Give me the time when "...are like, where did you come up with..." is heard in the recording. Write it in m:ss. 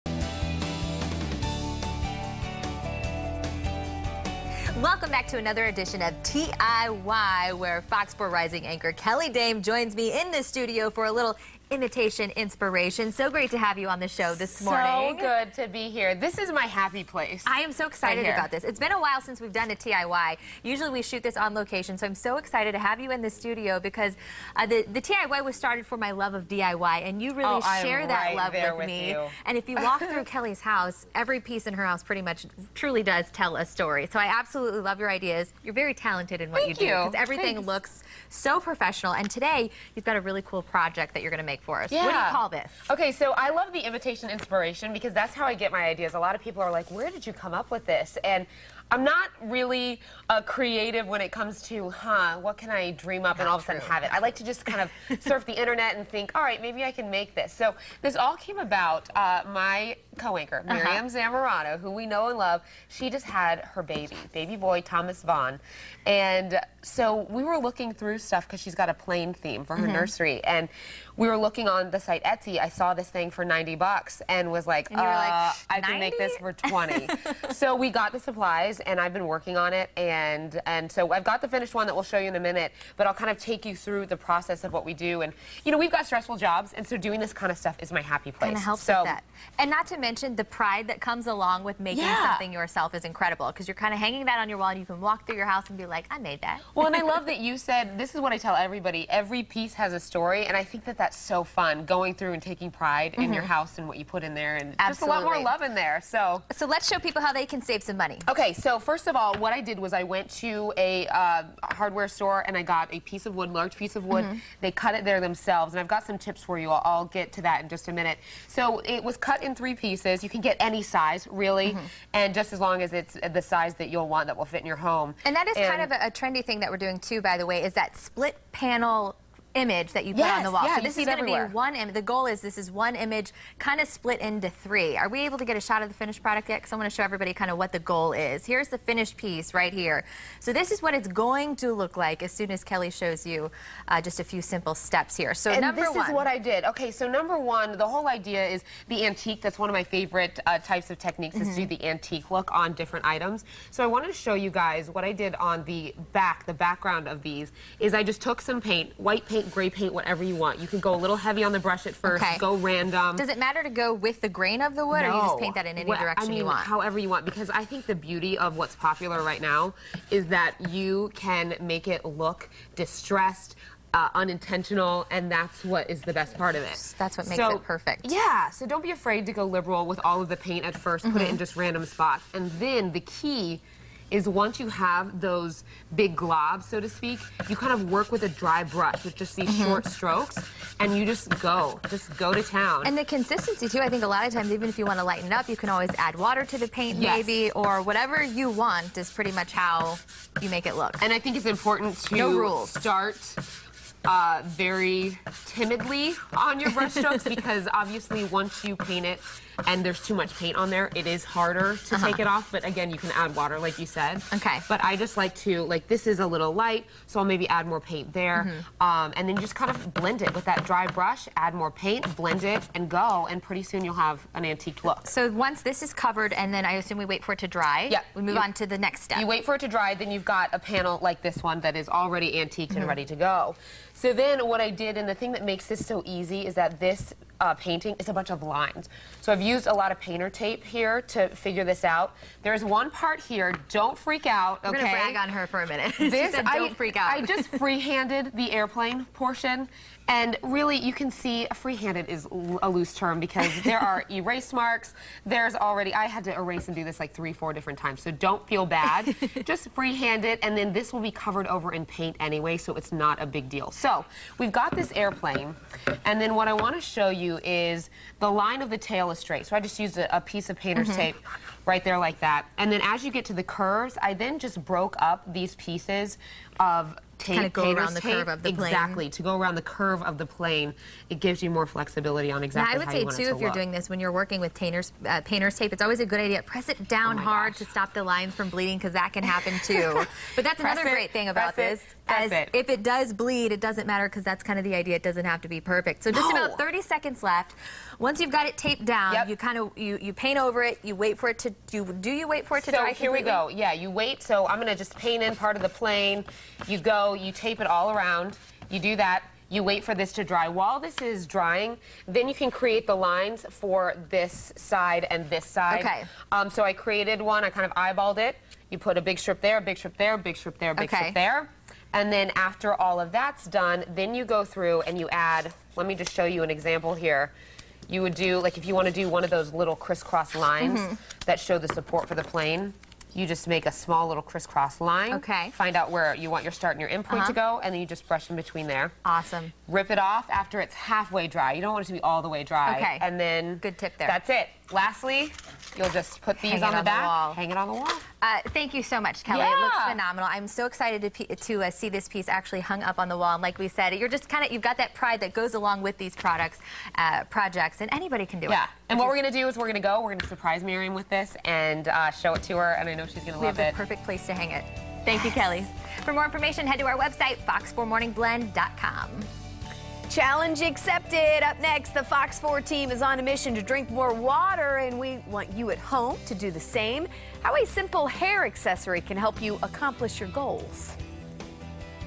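0:46.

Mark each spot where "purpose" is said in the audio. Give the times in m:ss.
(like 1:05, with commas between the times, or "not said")
not said.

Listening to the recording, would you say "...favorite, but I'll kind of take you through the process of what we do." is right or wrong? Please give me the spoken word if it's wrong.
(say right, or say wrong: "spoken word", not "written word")
wrong: "minute", not "favorite".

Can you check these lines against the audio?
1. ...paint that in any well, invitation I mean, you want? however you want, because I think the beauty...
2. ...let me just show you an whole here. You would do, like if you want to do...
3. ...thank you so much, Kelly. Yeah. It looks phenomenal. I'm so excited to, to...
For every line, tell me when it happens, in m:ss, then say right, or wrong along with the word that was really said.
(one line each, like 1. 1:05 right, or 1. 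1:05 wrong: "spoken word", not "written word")
1. 2:45 wrong: "direction", not "invitation"
2. 5:25 wrong: "example", not "whole"
3. 5:48 right.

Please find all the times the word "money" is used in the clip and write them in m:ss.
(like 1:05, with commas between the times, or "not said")
1:47.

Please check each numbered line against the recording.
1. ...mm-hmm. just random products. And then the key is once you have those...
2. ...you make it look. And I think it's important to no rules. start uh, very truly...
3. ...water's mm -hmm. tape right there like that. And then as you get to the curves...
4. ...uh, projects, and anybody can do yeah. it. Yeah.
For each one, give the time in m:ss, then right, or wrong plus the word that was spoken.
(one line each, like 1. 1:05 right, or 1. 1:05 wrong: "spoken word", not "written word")
1. 3:01 wrong: "spots", not "products"
2. 3:20 wrong: "timidly", not "truly"
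3. 4:30 wrong: "painter", not "water"
4. 5:56 right.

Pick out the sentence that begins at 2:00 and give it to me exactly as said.
You can get any size, really, mm -hmm.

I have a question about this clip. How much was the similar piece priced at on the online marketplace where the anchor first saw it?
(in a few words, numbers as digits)
$90.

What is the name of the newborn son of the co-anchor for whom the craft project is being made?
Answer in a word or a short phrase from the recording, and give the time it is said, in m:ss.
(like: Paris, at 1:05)
Thomas Vaughn, at 1:04.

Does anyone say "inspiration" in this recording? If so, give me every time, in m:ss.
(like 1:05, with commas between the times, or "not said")
0:12, 0:44.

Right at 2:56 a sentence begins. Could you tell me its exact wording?
That's what makes so, it perfect.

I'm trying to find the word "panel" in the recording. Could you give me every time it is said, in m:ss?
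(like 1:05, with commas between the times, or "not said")
2:08, 3:50.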